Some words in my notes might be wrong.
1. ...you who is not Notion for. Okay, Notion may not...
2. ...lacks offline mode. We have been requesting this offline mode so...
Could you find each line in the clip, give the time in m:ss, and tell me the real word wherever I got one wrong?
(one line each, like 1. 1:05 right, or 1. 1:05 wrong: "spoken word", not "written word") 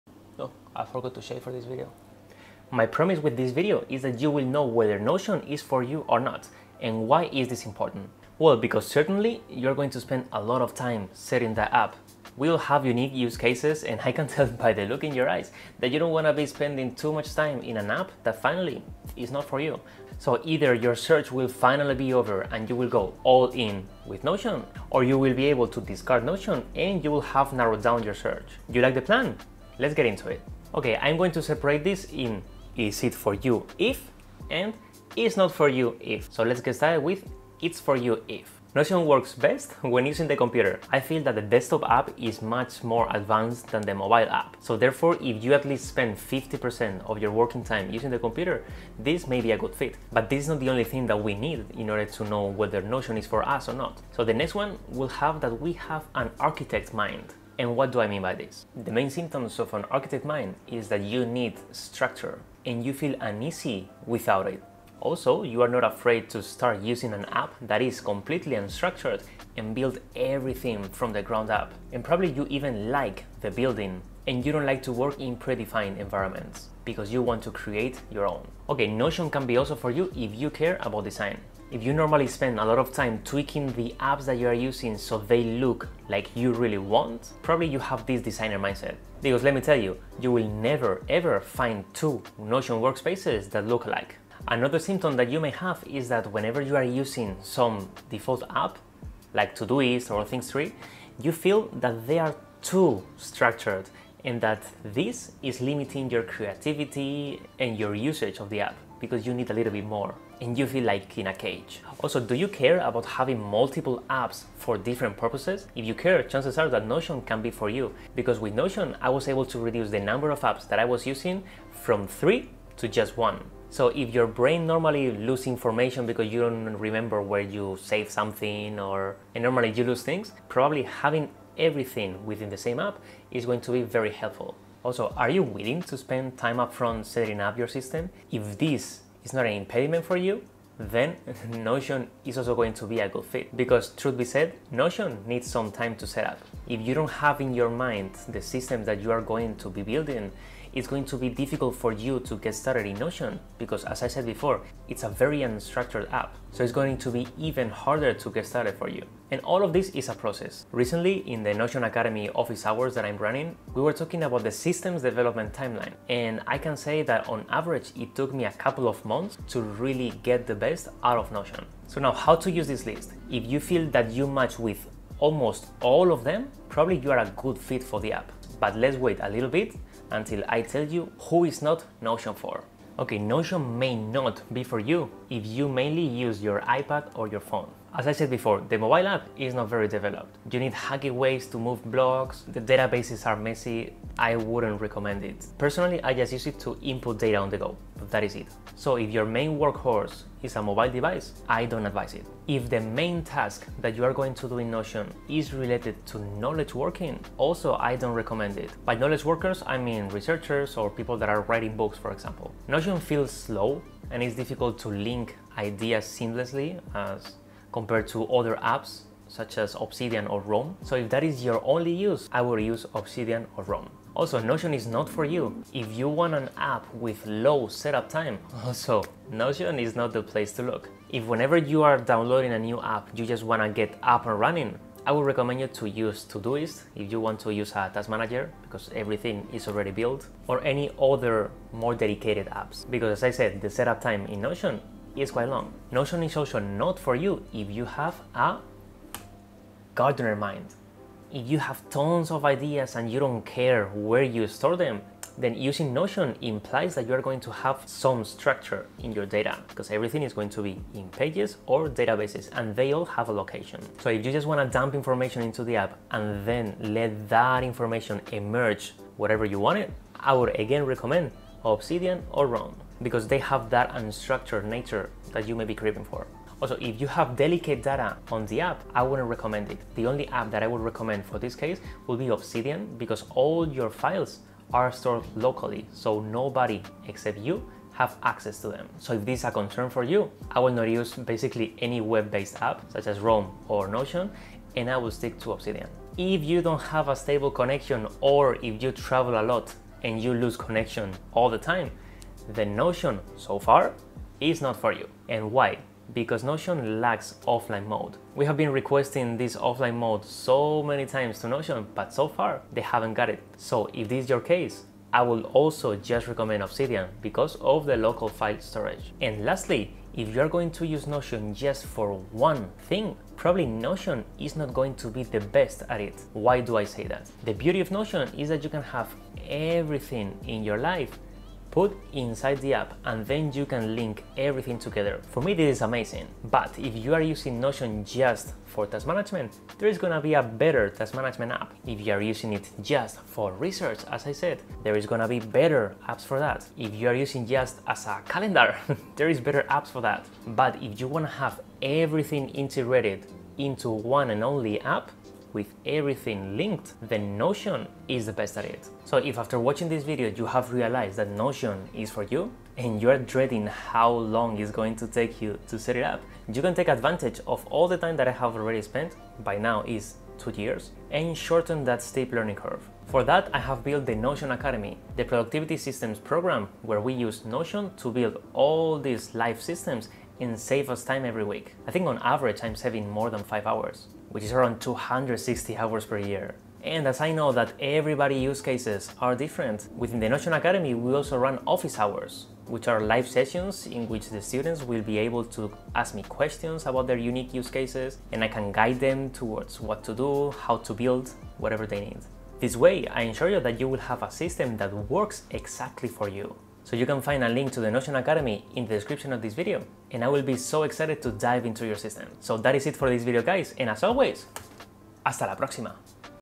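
1. 3:00 right
2. 5:07 right.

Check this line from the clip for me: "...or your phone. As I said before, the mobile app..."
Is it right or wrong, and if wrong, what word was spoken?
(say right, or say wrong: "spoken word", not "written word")
right.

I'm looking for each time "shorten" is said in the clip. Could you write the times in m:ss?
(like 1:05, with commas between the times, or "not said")
6:11.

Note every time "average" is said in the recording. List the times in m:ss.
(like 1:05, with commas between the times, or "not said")
2:47, 6:22.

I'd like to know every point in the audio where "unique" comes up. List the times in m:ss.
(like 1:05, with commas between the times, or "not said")
0:12, 6:37.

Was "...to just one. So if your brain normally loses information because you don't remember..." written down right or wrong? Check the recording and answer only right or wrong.
right.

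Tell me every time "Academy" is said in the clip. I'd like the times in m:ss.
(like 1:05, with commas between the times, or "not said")
2:41, 6:14, 6:30, 6:48.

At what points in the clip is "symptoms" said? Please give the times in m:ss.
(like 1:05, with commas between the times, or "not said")
0:59, 1:34.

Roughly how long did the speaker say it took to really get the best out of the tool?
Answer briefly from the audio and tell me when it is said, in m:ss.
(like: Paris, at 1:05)
A couple of months, at 2:48.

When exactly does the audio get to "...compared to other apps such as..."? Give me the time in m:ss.
3:37.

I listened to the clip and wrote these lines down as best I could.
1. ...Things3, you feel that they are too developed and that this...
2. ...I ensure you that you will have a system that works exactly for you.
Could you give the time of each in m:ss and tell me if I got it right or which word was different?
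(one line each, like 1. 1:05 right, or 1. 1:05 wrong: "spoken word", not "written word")
1. 1:40 wrong: "structured", not "developed"
2. 6:43 right.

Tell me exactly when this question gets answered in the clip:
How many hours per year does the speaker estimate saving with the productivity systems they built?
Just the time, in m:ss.
6:24.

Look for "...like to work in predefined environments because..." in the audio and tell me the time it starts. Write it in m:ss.
1:14.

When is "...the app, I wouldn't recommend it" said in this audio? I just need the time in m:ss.
4:38.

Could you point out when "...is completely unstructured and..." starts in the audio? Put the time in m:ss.
1:07.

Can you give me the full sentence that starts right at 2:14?
Also, are you willing to spend time upfront setting up your system?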